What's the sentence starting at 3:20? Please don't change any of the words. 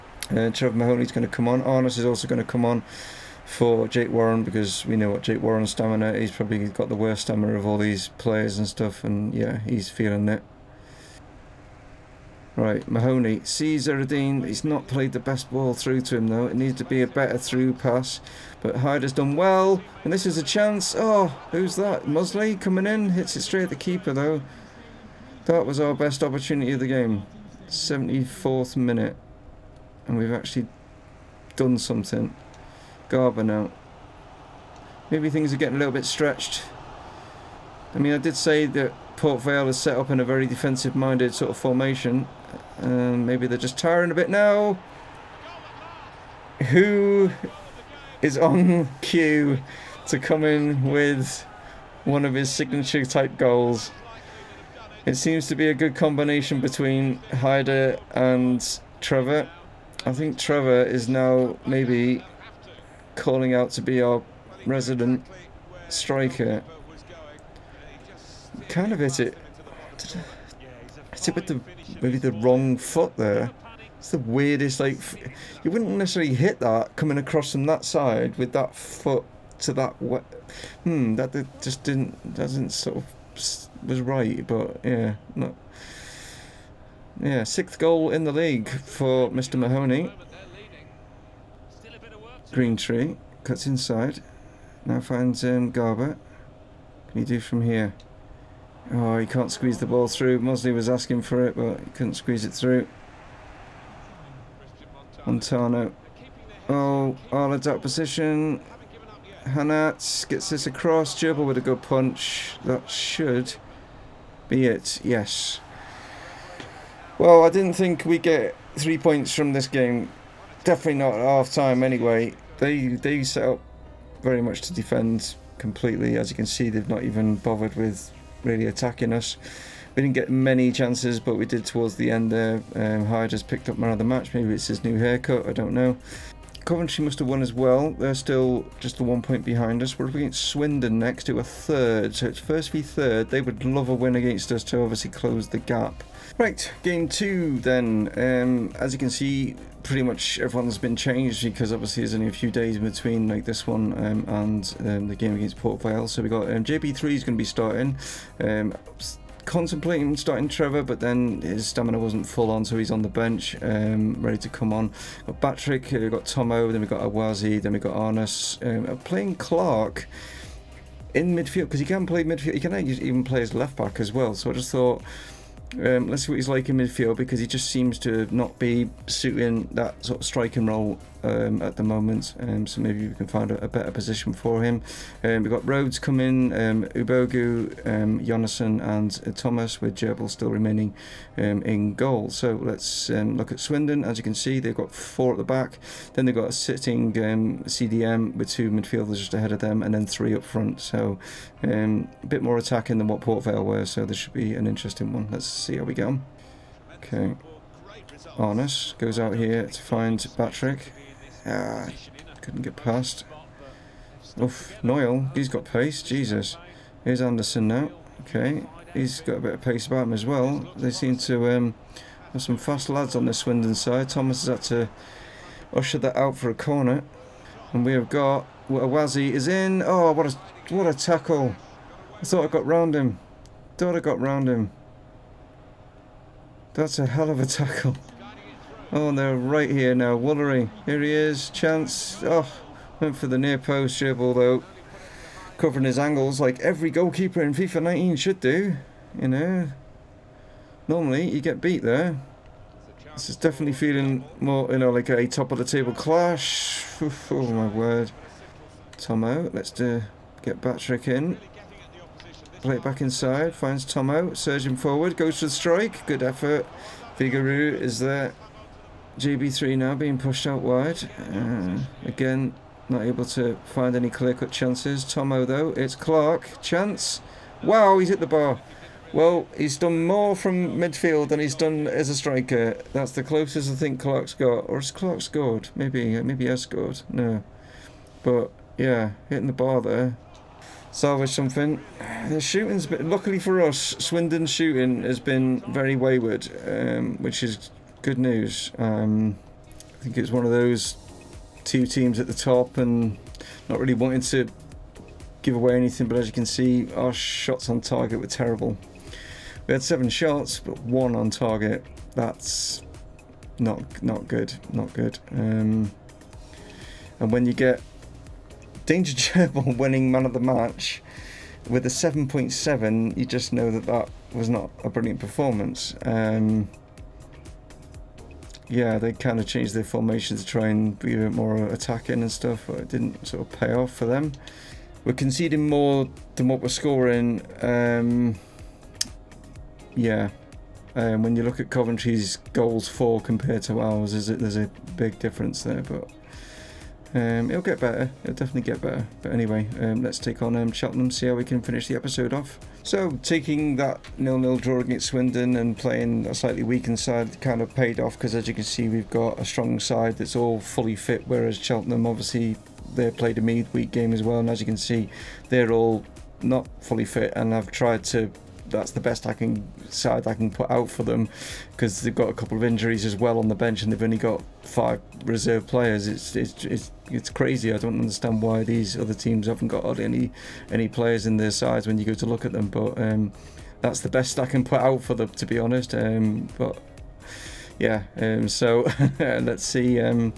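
So a bit more attacking than what Port Vale were, so this should be an interesting one.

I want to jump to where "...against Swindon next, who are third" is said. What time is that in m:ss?
2:20.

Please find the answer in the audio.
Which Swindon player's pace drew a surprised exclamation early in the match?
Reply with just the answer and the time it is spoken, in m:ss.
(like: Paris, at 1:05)
Noyle, at 3:34.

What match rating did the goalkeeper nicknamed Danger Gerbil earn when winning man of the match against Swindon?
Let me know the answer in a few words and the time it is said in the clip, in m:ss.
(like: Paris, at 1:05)
7.7, at 5:21.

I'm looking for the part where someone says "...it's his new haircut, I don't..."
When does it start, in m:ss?
2:14.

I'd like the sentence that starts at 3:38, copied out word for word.
He's got a bit of pace about him as well.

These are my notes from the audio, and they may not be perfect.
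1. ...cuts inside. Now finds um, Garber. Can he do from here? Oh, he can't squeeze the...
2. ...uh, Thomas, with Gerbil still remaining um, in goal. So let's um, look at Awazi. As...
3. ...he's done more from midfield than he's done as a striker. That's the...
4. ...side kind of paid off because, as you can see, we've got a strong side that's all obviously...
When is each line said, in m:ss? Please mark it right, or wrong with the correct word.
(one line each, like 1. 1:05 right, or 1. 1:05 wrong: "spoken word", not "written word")
1. 1:33 right
2. 3:09 wrong: "Swindon", not "Awazi"
3. 4:39 right
4. 5:56 wrong: "fully", not "obviously".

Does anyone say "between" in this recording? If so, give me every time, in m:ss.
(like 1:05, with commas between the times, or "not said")
0:56, 2:32.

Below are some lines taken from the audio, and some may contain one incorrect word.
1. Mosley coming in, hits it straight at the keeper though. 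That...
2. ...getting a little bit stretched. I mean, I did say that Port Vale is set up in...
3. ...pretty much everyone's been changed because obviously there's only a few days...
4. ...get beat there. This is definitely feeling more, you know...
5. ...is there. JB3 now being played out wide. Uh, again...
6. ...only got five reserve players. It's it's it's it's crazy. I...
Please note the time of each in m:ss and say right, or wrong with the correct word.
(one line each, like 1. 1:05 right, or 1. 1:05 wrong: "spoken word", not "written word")
1. 0:22 right
2. 0:35 right
3. 2:29 right
4. 4:11 right
5. 4:27 wrong: "pushed", not "played"
6. 6:14 right.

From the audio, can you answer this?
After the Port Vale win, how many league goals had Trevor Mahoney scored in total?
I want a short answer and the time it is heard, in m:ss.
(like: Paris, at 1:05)
6, at 1:27.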